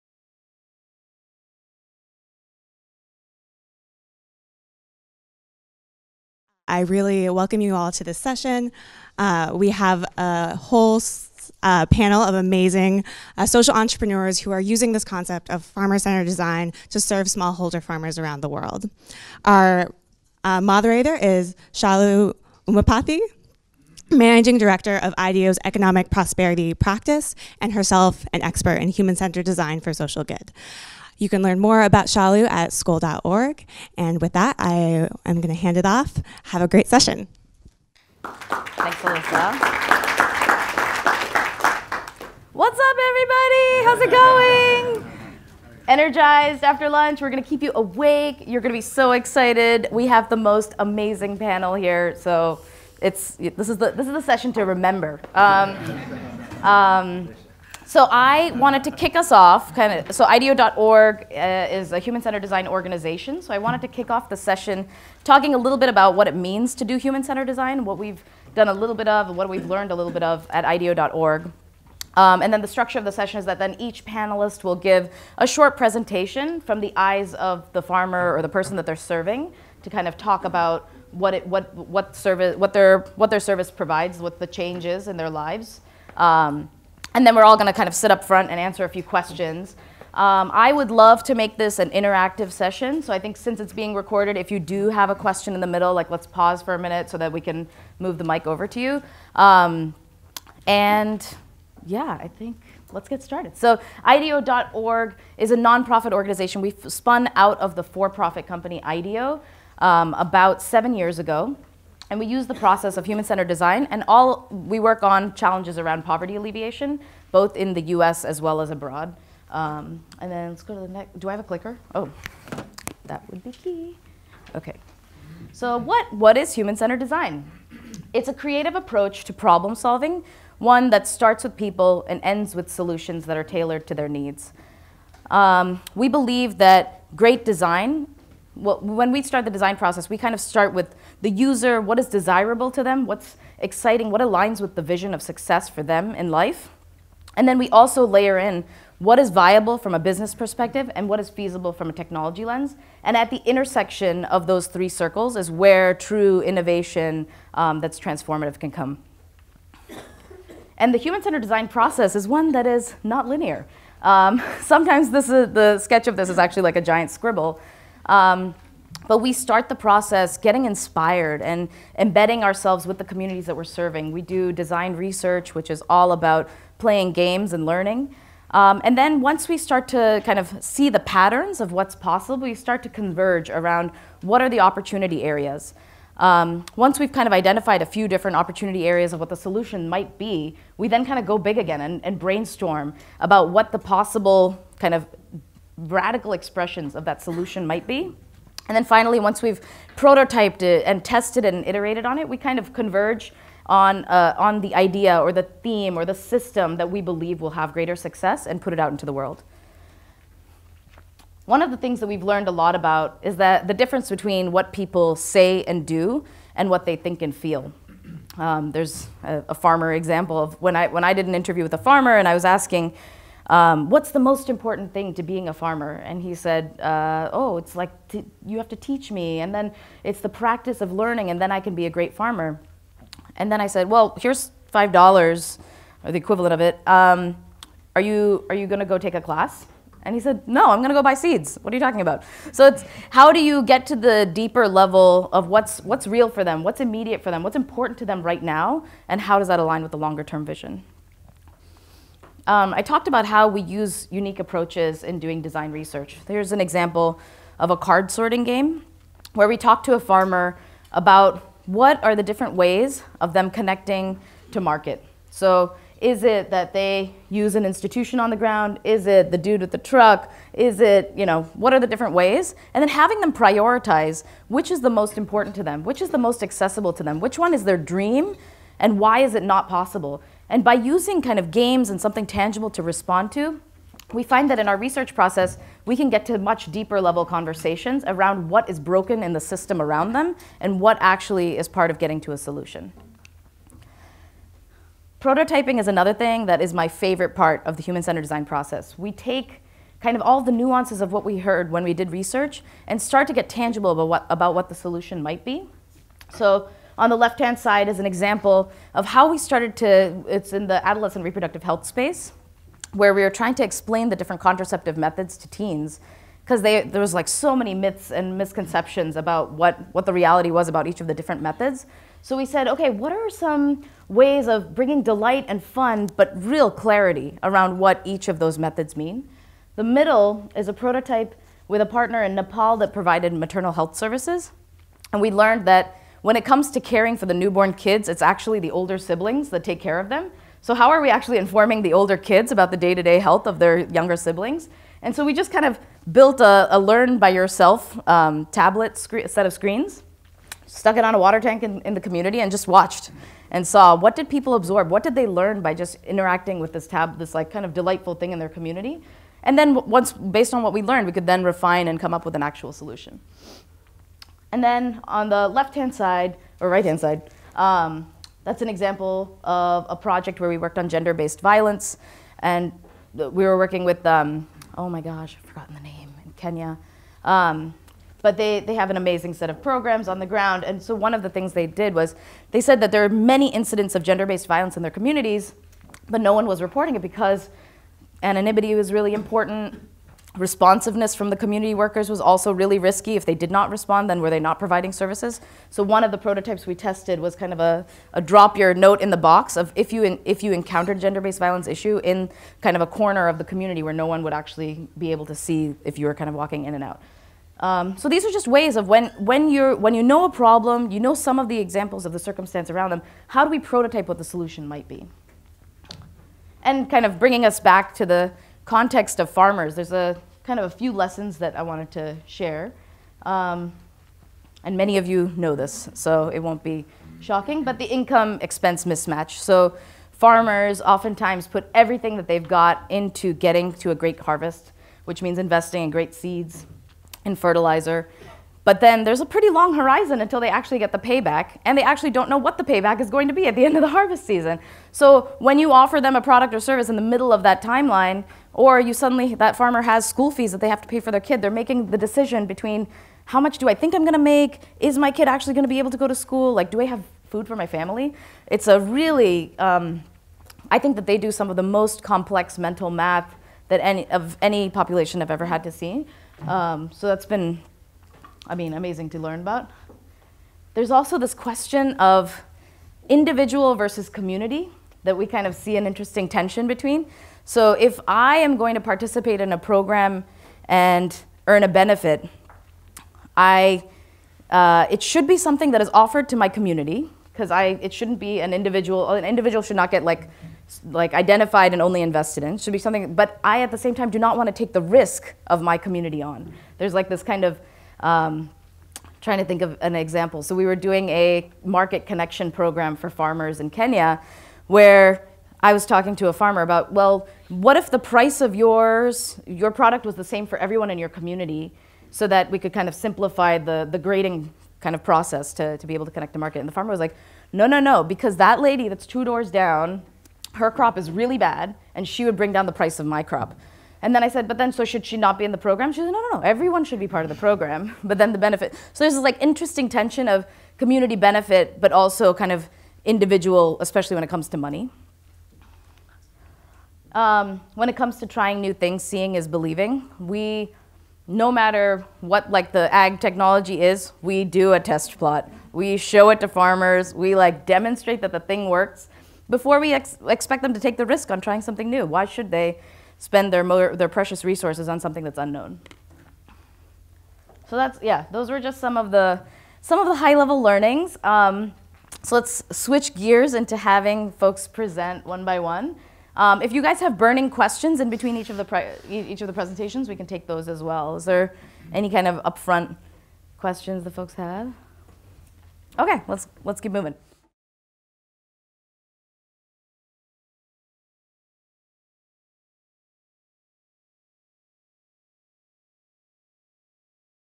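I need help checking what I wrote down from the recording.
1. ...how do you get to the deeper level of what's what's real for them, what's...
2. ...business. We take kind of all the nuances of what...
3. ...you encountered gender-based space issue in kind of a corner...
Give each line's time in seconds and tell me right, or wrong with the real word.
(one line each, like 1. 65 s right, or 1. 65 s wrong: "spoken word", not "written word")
1. 243 s right
2. 298 s wrong: "process", not "business"
3. 400 s wrong: "violence", not "space".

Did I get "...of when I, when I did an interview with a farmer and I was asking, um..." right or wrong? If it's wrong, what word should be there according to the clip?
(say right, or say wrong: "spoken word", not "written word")
right.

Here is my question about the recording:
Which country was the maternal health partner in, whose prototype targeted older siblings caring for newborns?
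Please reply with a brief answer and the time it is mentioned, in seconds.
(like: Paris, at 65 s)
Nepal, at 332 s.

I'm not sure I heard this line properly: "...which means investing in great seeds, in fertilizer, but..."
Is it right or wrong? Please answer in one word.
right.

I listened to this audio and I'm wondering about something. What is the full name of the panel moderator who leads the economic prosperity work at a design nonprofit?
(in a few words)
Shalu Umapathy.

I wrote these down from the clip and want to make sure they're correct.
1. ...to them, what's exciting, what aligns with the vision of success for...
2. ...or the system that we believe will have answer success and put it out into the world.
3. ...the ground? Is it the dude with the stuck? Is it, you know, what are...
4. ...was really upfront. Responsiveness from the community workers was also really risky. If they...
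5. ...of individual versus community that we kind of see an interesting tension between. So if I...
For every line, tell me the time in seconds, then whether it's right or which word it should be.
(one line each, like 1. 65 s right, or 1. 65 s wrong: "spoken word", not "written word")
1. 142 s right
2. 205 s wrong: "greater", not "answer"
3. 268 s wrong: "truck", not "stuck"
4. 388 s wrong: "important", not "upfront"
5. 471 s right.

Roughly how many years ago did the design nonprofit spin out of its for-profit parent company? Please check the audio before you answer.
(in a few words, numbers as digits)
7.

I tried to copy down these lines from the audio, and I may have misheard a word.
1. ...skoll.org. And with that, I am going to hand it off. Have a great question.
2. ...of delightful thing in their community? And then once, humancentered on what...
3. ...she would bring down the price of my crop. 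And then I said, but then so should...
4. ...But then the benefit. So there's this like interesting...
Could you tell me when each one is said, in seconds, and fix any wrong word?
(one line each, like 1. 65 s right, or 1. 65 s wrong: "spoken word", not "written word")
1. 32 s wrong: "session", not "question"
2. 357 s wrong: "based", not "humancentered"
3. 522 s right
4. 528 s right.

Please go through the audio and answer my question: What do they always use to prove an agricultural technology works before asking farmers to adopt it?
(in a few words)
a test plot.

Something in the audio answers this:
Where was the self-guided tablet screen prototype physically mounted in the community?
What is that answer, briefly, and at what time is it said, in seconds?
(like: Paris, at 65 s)
a water tank, at 351 s.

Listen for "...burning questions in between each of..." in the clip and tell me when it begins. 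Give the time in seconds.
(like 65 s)
567 s.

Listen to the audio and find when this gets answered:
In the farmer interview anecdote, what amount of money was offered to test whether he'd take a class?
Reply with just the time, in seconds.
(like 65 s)
234 s.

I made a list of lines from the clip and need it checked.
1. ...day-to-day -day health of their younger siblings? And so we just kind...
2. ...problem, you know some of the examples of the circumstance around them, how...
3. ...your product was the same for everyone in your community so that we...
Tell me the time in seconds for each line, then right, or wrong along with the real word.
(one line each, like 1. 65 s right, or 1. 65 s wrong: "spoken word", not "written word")
1. 342 s right
2. 410 s right
3. 509 s right.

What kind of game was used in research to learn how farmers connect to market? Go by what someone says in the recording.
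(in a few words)
card sorting game.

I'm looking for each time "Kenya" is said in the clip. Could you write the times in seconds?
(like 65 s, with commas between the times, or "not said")
376 s, 503 s.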